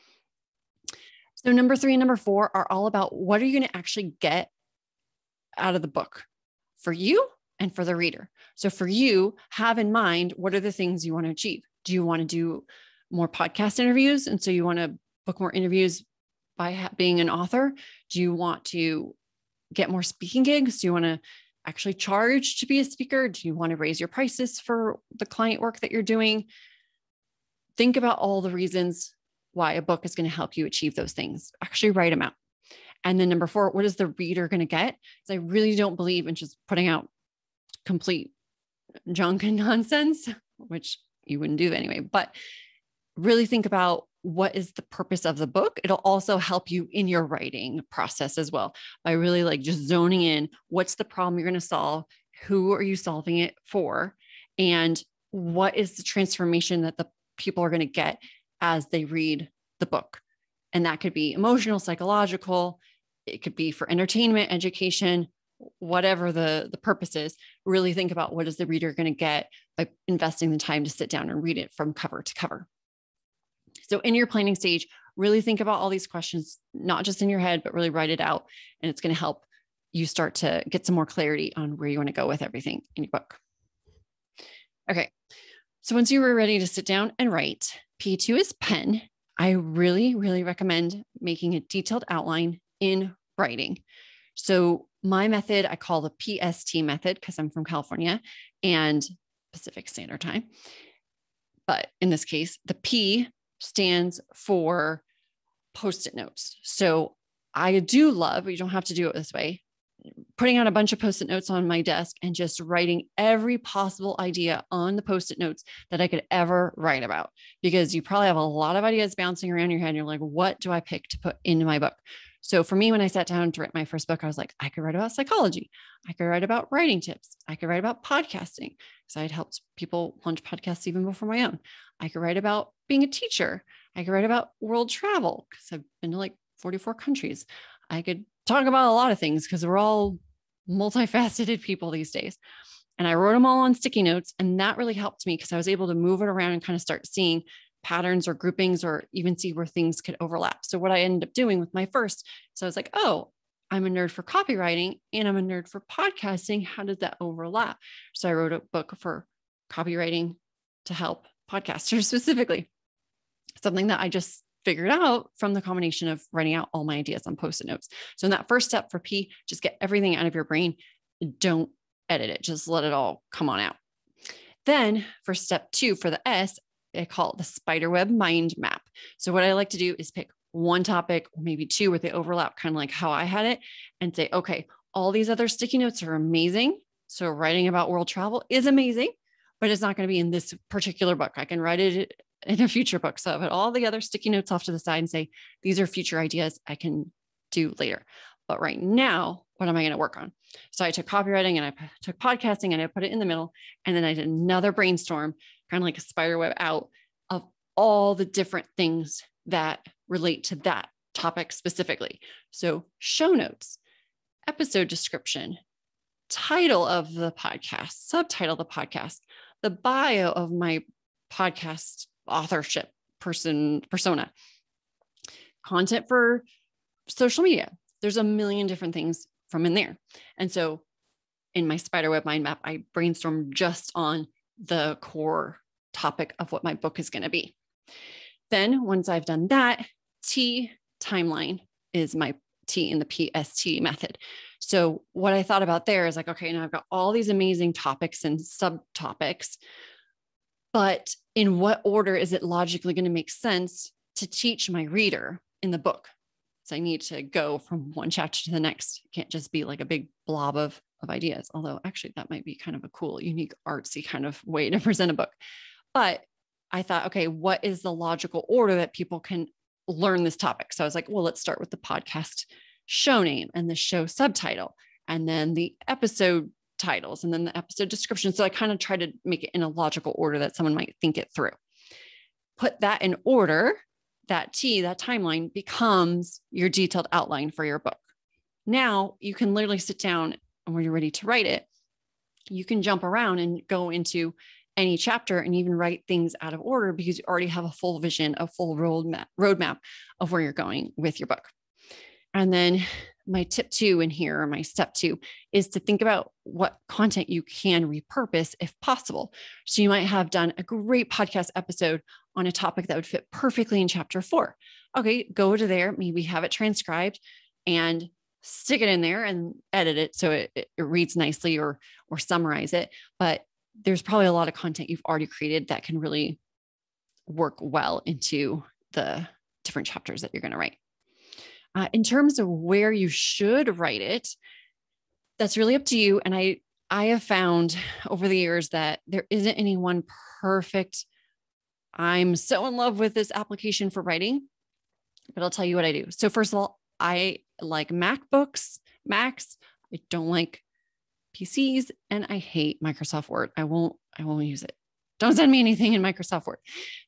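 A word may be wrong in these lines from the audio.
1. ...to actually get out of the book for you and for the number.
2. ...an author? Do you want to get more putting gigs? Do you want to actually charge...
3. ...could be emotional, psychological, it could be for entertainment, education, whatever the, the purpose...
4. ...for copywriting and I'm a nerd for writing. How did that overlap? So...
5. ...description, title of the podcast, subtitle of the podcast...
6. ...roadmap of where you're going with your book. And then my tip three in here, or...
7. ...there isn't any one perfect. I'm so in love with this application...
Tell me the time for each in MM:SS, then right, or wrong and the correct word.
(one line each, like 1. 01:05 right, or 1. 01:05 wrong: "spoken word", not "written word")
1. 00:03 wrong: "reader", not "number"
2. 00:17 wrong: "speaking", not "putting"
3. 01:00 right
4. 02:34 wrong: "podcasting", not "writing"
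5. 03:34 right
6. 04:59 wrong: "two", not "three"
7. 05:39 right.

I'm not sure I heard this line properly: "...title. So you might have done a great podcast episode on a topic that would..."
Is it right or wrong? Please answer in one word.
wrong.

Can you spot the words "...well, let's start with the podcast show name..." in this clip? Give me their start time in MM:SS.
04:31.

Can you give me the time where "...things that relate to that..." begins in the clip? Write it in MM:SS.
03:28.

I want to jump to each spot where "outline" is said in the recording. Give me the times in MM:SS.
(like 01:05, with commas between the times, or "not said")
01:32, 04:47.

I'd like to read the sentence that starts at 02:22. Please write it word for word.
And I wrote them all on sticky notes.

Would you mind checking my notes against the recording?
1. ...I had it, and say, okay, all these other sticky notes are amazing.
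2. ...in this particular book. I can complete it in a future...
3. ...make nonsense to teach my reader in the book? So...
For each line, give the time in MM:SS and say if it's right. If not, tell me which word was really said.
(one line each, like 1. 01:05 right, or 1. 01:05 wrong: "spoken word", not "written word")
1. 03:03 right
2. 03:10 wrong: "write", not "complete"
3. 04:13 wrong: "sense", not "nonsense".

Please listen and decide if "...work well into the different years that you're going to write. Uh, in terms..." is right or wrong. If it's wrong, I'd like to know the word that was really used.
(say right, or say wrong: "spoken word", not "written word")
wrong: "chapters", not "years".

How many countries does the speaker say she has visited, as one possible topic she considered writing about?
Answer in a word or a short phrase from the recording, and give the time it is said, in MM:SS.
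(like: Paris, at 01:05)
44, at 02:16.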